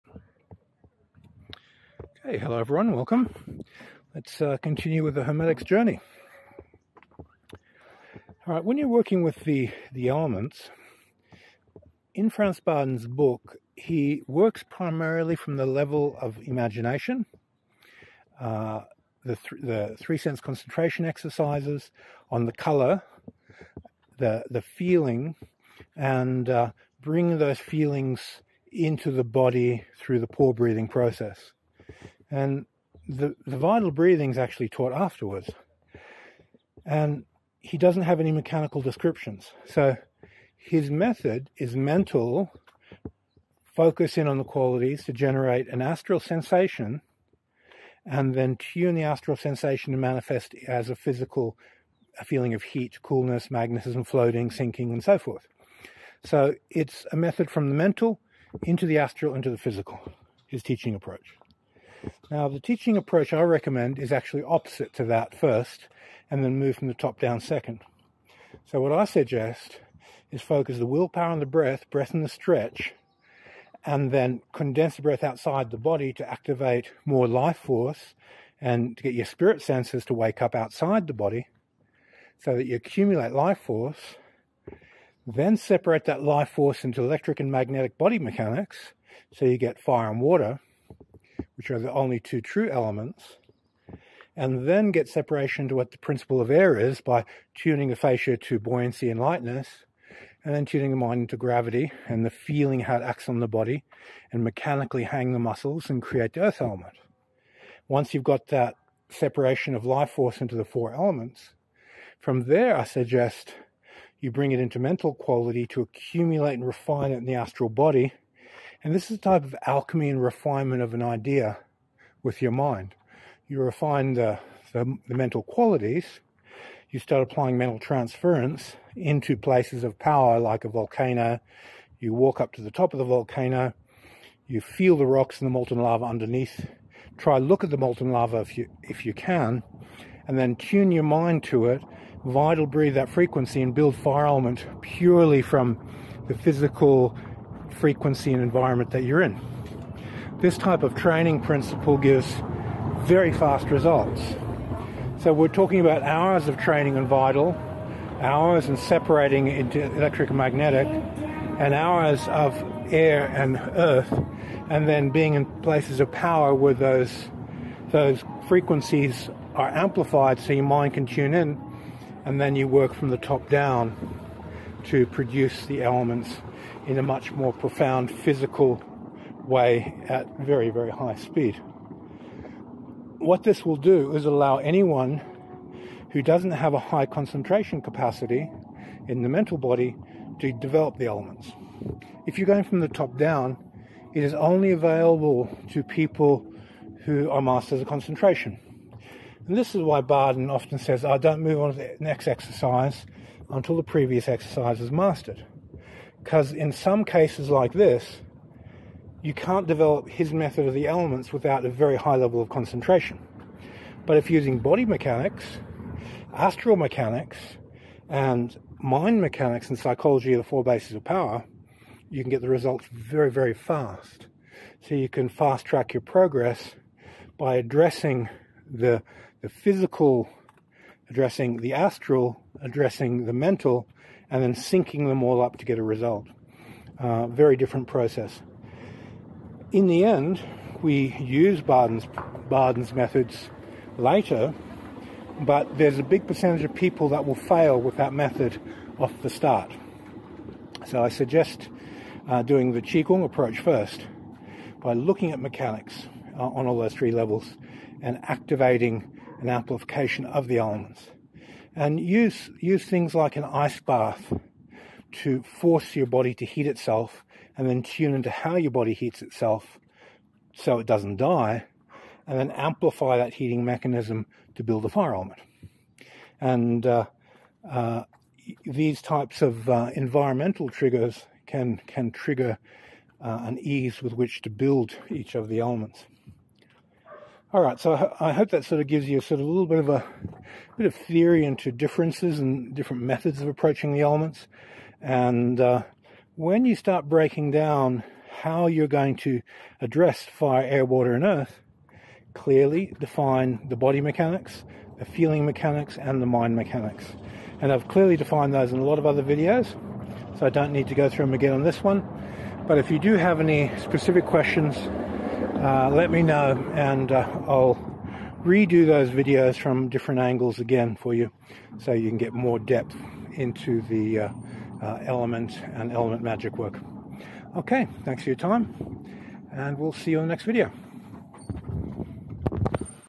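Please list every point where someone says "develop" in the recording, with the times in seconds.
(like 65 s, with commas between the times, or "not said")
190 s, 209 s.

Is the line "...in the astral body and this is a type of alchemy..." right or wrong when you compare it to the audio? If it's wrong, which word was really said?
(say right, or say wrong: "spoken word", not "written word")
right.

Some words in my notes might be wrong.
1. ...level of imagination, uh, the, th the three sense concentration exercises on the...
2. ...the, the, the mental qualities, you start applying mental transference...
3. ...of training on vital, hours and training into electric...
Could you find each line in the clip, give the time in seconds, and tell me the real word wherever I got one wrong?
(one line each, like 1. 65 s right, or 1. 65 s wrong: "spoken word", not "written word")
1. 15 s right
2. 124 s right
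3. 156 s wrong: "separating", not "training".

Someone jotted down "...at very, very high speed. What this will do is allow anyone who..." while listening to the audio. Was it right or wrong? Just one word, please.
right.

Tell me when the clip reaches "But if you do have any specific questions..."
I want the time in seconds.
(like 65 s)
312 s.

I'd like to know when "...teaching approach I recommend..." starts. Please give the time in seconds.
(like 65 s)
62 s.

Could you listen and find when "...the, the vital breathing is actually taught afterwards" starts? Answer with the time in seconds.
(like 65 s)
33 s.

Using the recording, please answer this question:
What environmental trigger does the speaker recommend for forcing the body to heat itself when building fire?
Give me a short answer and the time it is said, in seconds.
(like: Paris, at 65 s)
An ice bath, at 263 s.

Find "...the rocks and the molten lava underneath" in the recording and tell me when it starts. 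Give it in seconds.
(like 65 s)
134 s.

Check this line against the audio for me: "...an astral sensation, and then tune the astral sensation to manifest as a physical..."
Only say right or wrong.
right.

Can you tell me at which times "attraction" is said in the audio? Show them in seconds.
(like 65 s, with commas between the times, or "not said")
not said.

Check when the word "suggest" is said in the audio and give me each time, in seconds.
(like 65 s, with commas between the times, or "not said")
69 s, 112 s, 251 s.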